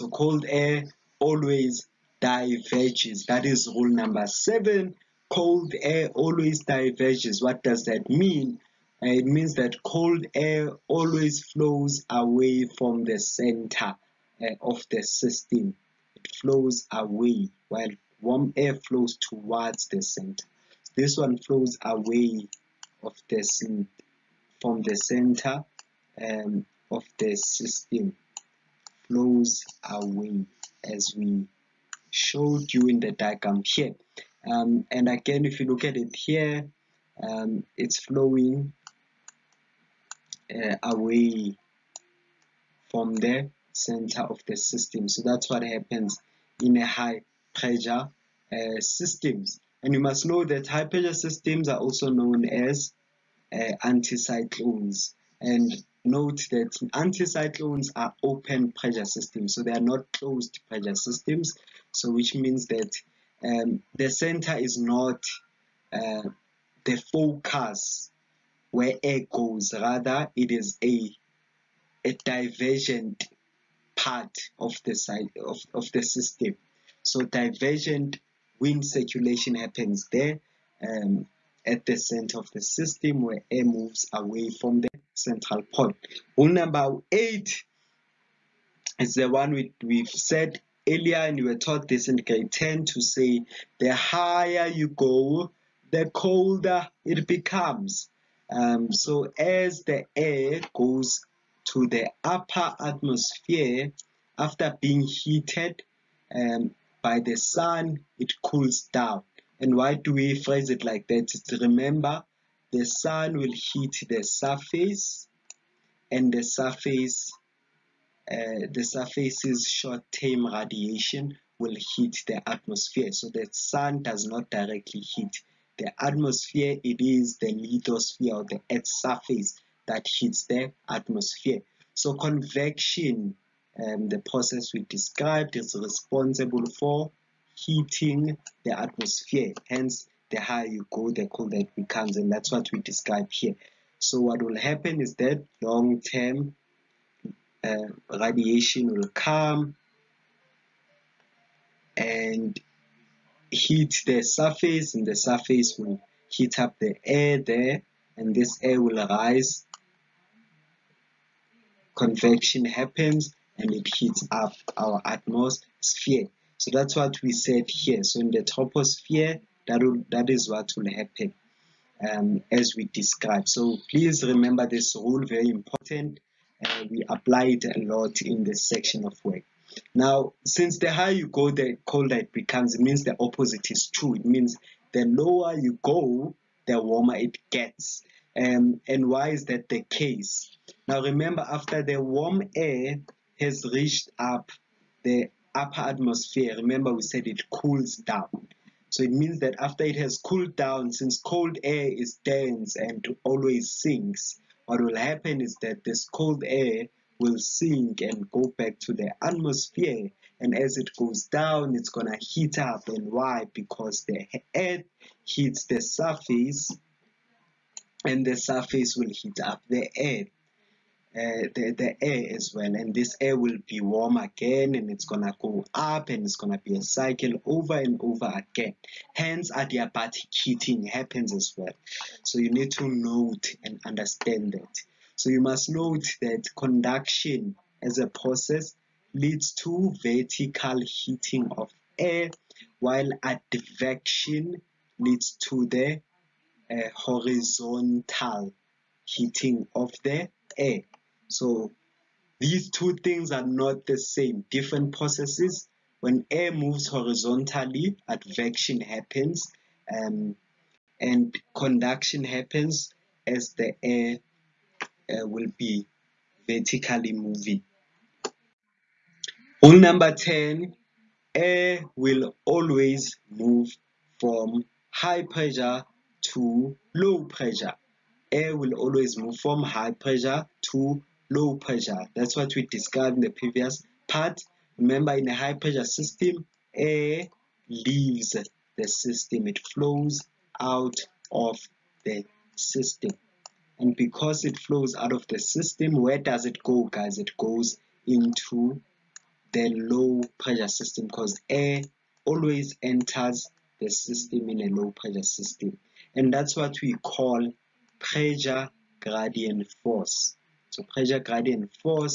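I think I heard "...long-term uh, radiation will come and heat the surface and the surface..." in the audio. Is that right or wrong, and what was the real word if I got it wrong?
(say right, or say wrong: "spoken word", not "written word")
right.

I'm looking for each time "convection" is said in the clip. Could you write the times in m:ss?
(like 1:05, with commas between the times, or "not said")
2:12, 2:41.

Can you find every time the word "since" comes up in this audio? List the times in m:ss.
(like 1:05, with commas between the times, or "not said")
3:00, 3:20.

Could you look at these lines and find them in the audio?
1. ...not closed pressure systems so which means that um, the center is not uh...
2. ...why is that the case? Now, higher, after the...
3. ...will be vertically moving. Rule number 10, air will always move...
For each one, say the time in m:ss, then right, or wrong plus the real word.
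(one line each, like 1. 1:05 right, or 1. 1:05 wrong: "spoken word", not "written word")
1. 0:59 right
2. 3:09 wrong: "remember", not "higher"
3. 4:25 right.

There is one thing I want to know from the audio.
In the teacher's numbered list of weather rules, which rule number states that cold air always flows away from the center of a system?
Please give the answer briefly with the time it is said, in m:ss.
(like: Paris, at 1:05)
7, at 0:04.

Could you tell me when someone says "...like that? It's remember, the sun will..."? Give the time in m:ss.
1:50.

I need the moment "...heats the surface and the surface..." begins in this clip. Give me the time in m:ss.
3:35.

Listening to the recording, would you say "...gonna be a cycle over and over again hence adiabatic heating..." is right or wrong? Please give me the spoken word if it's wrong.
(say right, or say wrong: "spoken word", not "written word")
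right.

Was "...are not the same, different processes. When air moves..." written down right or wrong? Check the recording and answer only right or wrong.
right.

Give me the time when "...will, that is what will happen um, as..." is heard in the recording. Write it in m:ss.
2:49.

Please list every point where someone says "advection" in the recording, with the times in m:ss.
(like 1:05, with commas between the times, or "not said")
4:03, 4:18.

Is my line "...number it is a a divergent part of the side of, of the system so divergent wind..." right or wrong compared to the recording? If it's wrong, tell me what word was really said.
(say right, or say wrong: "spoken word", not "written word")
wrong: "rather", not "number".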